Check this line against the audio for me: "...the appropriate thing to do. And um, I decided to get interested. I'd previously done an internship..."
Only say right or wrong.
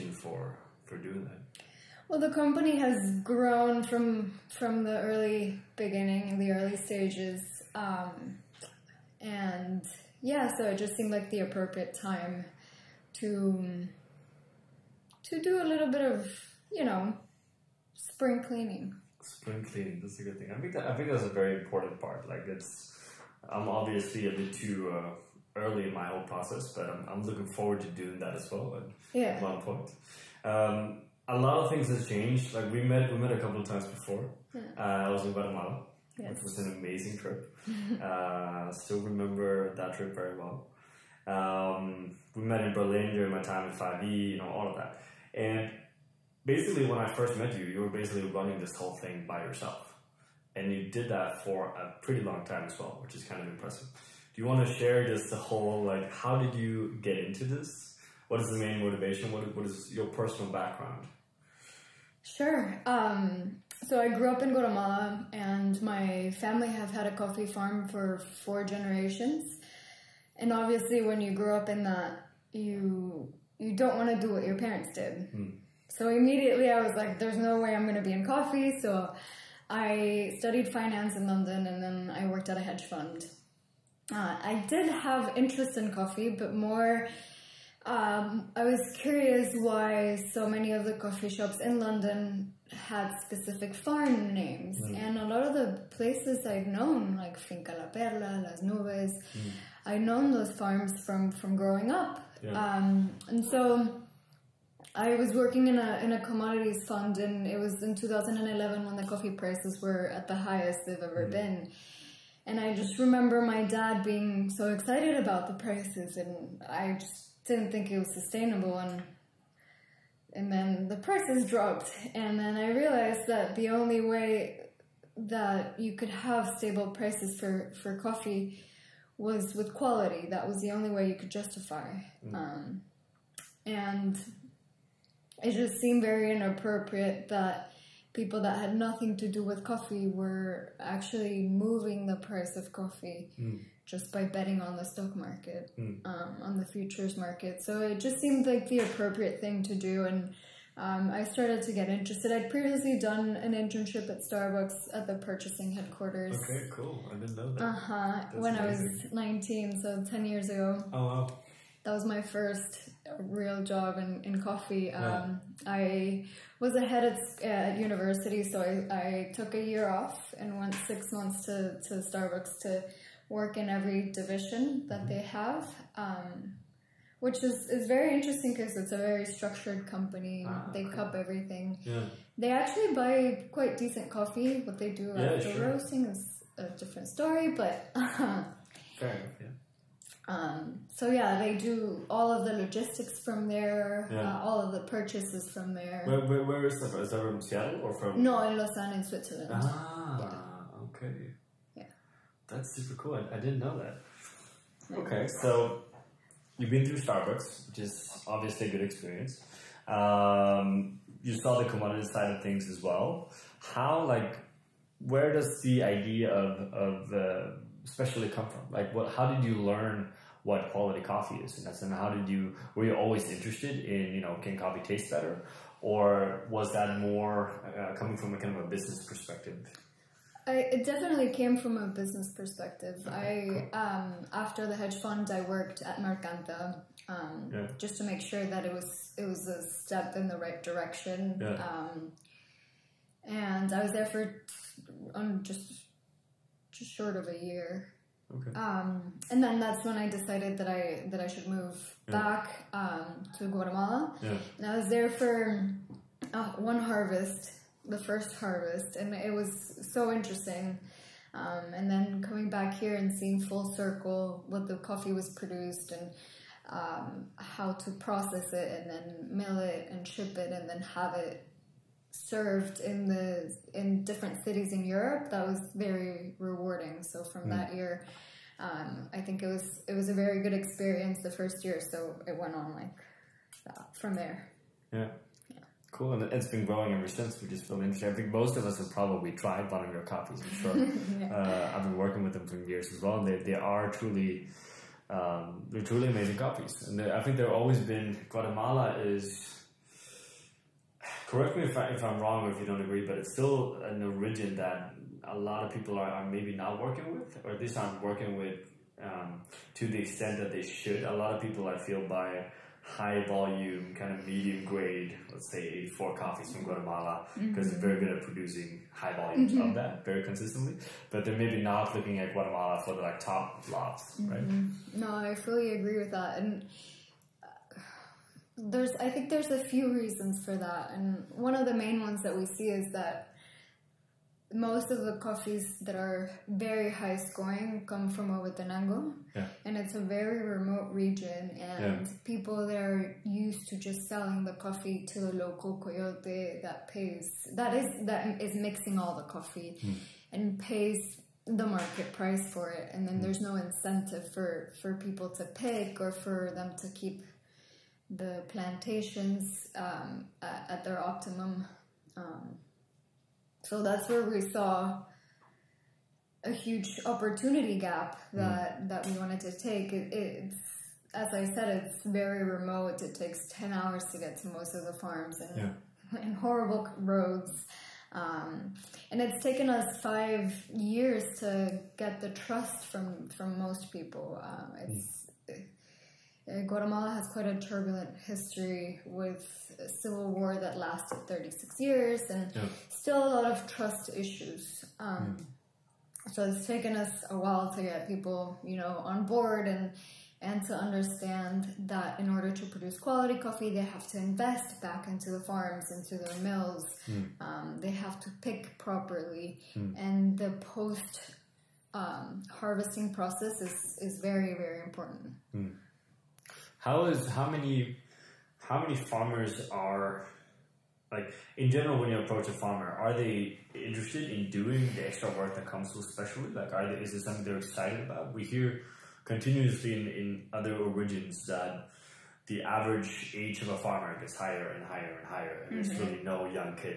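wrong.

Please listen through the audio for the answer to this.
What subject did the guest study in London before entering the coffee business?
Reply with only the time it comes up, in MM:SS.
01:20.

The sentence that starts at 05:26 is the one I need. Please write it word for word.
And uh, there's, I think there's a few reasons for that.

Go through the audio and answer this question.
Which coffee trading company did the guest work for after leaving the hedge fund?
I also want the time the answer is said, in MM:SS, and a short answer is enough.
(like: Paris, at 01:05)
Mercanta, at 03:55.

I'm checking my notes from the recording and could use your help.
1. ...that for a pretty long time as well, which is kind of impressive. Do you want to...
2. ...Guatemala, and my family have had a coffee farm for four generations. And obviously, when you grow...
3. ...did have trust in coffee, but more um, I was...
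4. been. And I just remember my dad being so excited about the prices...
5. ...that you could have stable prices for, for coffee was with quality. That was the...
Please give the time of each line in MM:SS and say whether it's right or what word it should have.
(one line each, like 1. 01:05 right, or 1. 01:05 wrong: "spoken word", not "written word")
1. 00:51 right
2. 01:04 right
3. 01:24 wrong: "interest", not "trust"
4. 01:51 right
5. 02:05 right.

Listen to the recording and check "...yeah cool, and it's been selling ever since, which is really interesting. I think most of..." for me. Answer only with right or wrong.
wrong.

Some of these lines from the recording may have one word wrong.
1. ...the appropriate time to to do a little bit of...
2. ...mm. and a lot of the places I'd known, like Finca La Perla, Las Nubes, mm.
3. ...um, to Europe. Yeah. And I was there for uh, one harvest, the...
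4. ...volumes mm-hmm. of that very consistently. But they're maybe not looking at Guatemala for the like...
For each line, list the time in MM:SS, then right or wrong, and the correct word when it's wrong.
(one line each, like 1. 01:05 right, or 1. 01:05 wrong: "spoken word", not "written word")
1. 00:11 right
2. 01:34 right
3. 04:12 wrong: "Guatemala", not "Europe"
4. 05:19 right.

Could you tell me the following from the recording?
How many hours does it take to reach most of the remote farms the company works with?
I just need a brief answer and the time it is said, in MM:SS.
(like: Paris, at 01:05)
10, at 06:13.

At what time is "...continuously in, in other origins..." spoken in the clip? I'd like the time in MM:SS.
07:09.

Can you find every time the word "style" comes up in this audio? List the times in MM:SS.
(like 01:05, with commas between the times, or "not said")
not said.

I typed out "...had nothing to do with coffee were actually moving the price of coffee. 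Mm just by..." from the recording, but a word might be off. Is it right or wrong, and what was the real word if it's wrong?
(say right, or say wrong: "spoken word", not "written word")
right.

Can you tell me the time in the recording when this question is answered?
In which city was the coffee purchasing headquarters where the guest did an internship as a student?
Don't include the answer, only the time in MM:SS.
03:18.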